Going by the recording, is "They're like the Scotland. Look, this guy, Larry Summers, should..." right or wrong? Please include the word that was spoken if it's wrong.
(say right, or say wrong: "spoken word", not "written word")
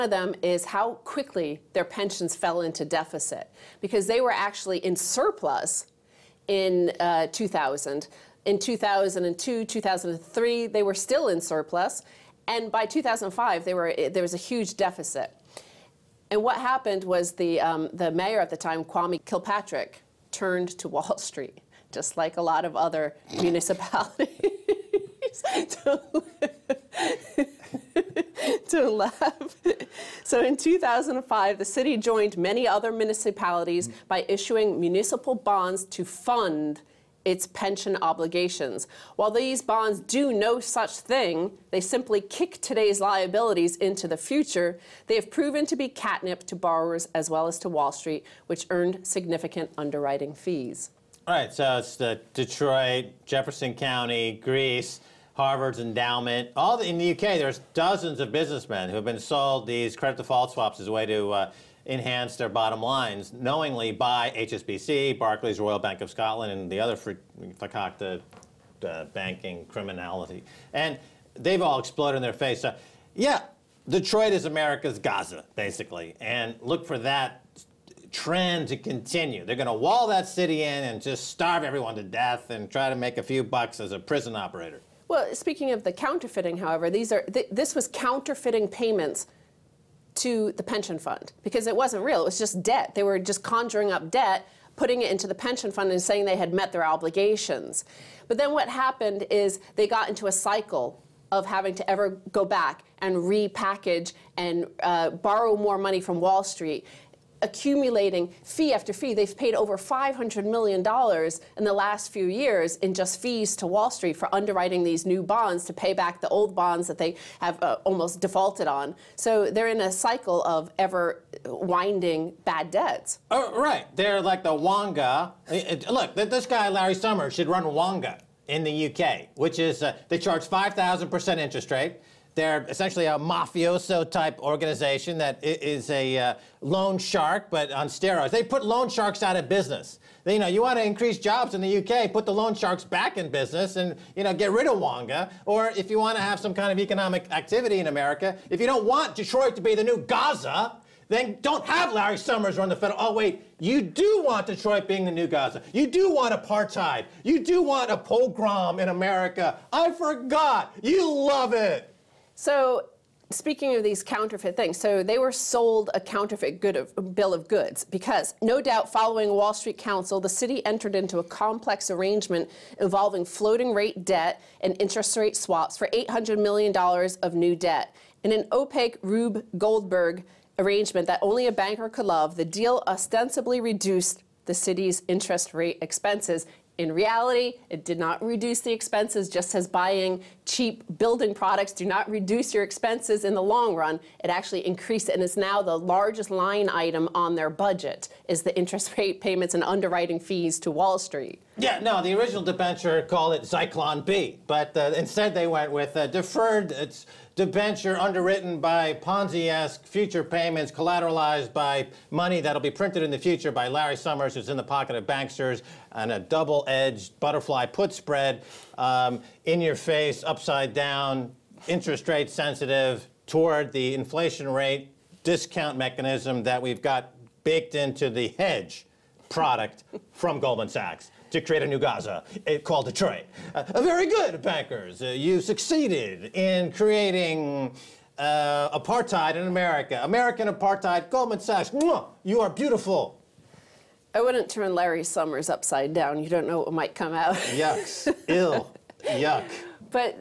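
wrong: "Wonga", not "Scotland".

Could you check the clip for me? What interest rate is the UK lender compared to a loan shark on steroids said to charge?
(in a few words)
5,000%.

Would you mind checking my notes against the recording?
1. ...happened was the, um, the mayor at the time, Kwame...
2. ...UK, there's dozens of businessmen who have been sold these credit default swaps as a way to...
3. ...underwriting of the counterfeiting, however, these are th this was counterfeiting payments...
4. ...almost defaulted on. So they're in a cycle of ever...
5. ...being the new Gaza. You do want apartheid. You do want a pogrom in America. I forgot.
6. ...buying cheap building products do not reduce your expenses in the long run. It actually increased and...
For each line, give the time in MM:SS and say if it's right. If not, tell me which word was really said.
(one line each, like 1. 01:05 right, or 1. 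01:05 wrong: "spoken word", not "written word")
1. 00:16 right
2. 00:57 right
3. 01:25 wrong: "speaking", not "underwriting"
4. 01:57 right
5. 02:34 right
6. 03:09 right.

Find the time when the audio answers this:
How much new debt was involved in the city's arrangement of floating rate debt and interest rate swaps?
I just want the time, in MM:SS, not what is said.
02:55.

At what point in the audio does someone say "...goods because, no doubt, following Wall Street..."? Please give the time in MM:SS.
02:47.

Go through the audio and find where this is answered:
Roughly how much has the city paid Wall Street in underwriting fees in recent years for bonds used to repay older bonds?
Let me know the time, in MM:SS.
01:49.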